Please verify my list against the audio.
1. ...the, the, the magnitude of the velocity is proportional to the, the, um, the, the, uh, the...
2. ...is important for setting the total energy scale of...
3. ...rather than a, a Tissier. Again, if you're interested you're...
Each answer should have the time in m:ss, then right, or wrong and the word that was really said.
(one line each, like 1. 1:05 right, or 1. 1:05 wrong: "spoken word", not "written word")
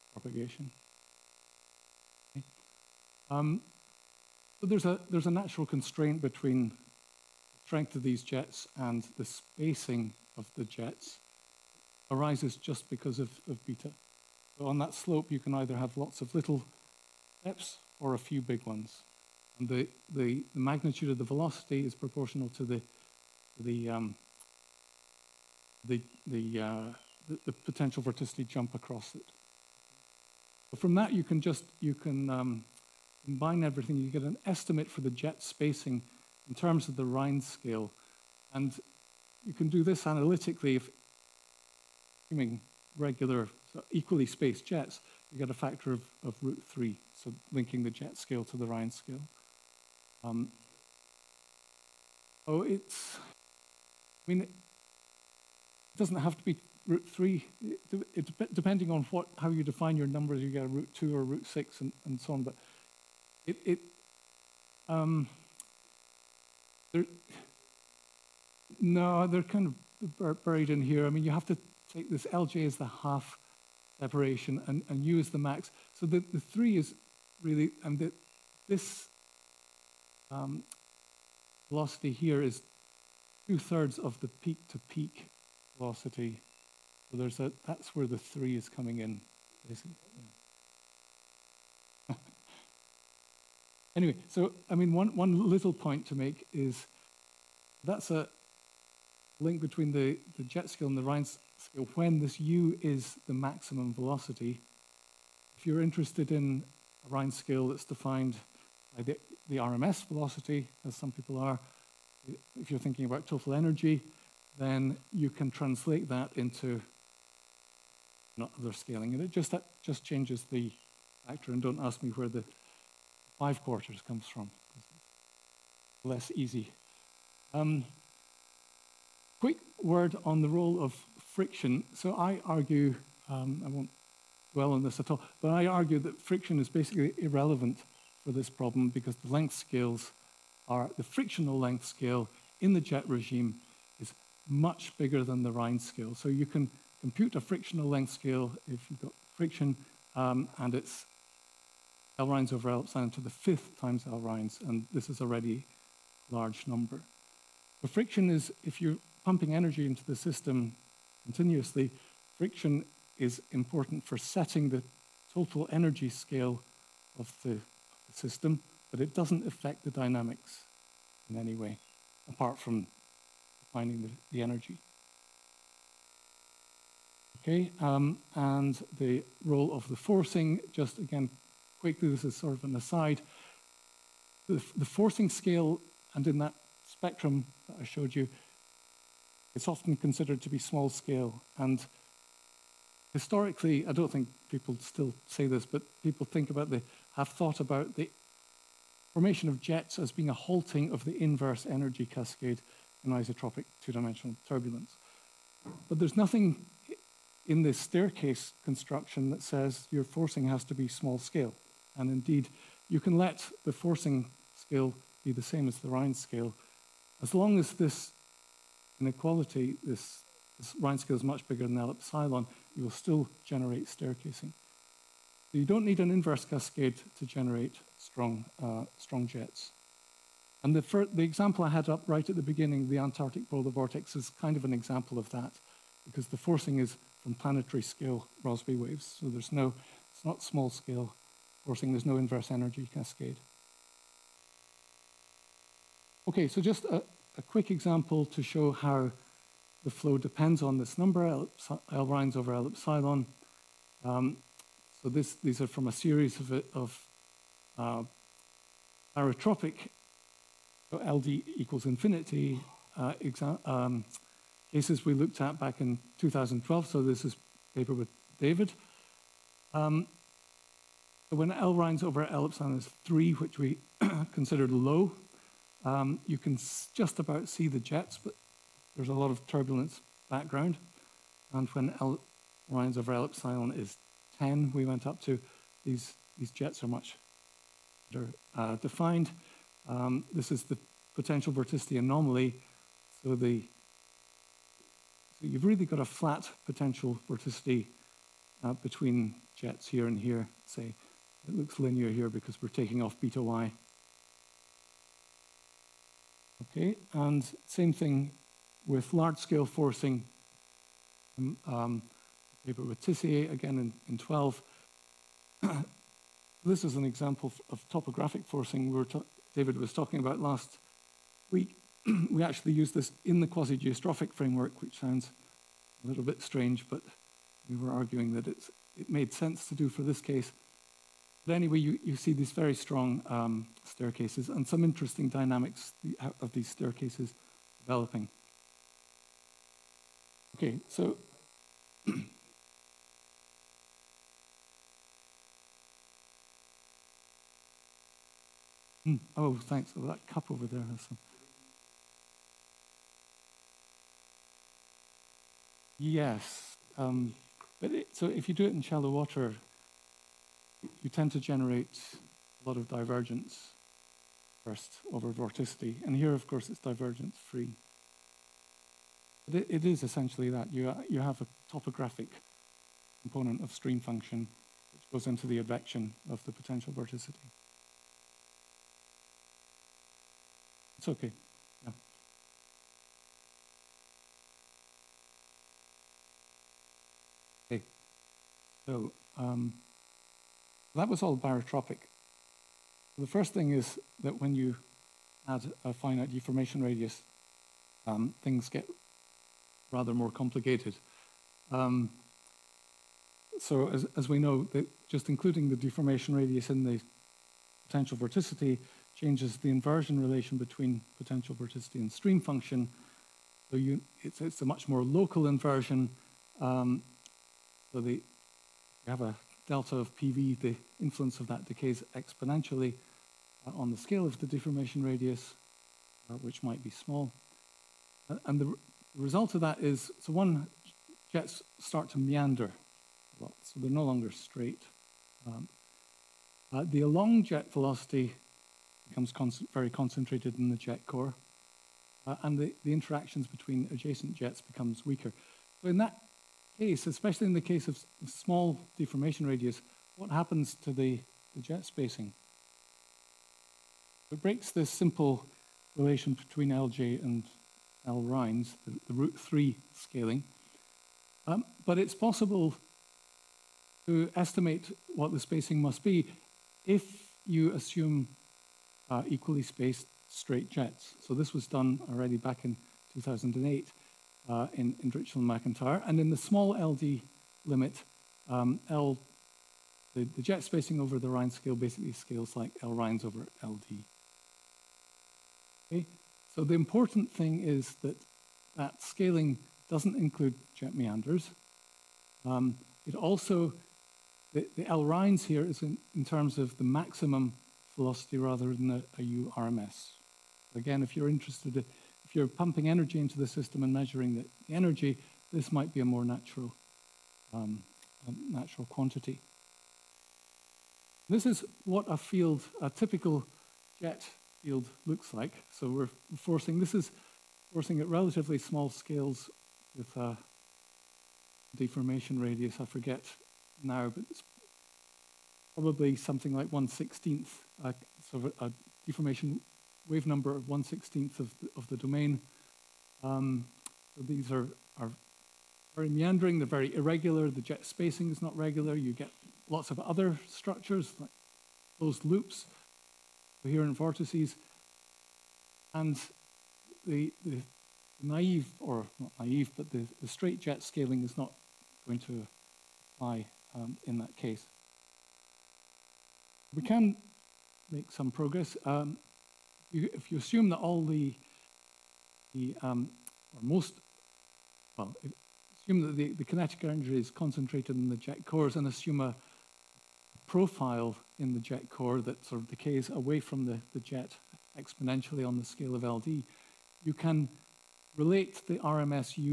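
1. 0:19 right
2. 2:43 right
3. 8:18 wrong: "URMS", not "Tissier".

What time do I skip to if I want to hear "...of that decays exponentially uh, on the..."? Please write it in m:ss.
7:01.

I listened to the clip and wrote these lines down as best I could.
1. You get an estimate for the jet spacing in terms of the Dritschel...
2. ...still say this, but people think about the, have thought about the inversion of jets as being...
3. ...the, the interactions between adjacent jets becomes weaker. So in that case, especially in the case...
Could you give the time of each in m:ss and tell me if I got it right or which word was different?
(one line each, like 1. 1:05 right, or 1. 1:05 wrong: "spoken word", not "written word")
1. 0:33 wrong: "Rhines", not "Dritschel"
2. 3:14 wrong: "formation", not "inversion"
3. 7:22 right.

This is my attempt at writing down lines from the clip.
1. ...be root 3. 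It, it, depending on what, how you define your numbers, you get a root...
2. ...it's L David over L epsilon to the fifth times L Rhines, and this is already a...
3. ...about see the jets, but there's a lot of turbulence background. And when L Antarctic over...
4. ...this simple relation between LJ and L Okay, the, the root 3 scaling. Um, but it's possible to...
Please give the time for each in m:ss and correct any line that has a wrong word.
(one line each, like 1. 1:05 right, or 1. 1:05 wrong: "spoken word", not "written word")
1. 0:56 right
2. 2:30 wrong: "Rhines", not "David"
3. 4:37 wrong: "Rhines", not "Antarctic"
4. 7:34 wrong: "Rhines", not "Okay".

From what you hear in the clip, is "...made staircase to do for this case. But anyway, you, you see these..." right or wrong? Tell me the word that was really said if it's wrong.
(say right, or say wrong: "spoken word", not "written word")
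wrong: "sense", not "staircase".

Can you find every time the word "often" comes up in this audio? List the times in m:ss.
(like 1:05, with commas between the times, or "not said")
3:09.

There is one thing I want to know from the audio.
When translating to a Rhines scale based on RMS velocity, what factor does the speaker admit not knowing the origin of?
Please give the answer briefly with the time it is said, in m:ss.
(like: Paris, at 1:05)
five quarters, at 2:03.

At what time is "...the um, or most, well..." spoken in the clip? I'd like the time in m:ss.
9:22.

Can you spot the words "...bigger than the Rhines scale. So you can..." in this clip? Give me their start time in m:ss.
2:24.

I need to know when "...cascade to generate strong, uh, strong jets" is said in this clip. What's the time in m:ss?
3:46.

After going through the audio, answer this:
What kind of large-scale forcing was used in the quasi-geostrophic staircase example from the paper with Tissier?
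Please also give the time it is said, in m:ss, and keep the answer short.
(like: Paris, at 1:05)
topographic forcing, at 5:17.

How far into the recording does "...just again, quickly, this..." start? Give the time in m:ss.
3:00.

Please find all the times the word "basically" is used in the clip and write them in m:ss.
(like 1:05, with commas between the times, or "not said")
1:29, 2:16, 8:01.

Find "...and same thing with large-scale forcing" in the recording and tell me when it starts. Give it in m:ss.
5:07.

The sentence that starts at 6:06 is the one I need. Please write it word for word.
And here, of course, it's divergence free.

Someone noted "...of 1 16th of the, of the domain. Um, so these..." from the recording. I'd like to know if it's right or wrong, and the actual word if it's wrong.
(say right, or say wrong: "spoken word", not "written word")
right.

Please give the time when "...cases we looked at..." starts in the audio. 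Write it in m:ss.
4:24.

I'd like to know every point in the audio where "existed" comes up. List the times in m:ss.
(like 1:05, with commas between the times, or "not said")
not said.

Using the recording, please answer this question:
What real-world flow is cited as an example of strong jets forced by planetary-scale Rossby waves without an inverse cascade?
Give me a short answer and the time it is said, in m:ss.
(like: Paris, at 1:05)
Antarctic polar vortex, at 3:52.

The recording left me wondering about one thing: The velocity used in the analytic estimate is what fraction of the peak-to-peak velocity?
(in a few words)
two-thirds.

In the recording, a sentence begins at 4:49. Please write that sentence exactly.
Um, this is the potential vorticity anomaly.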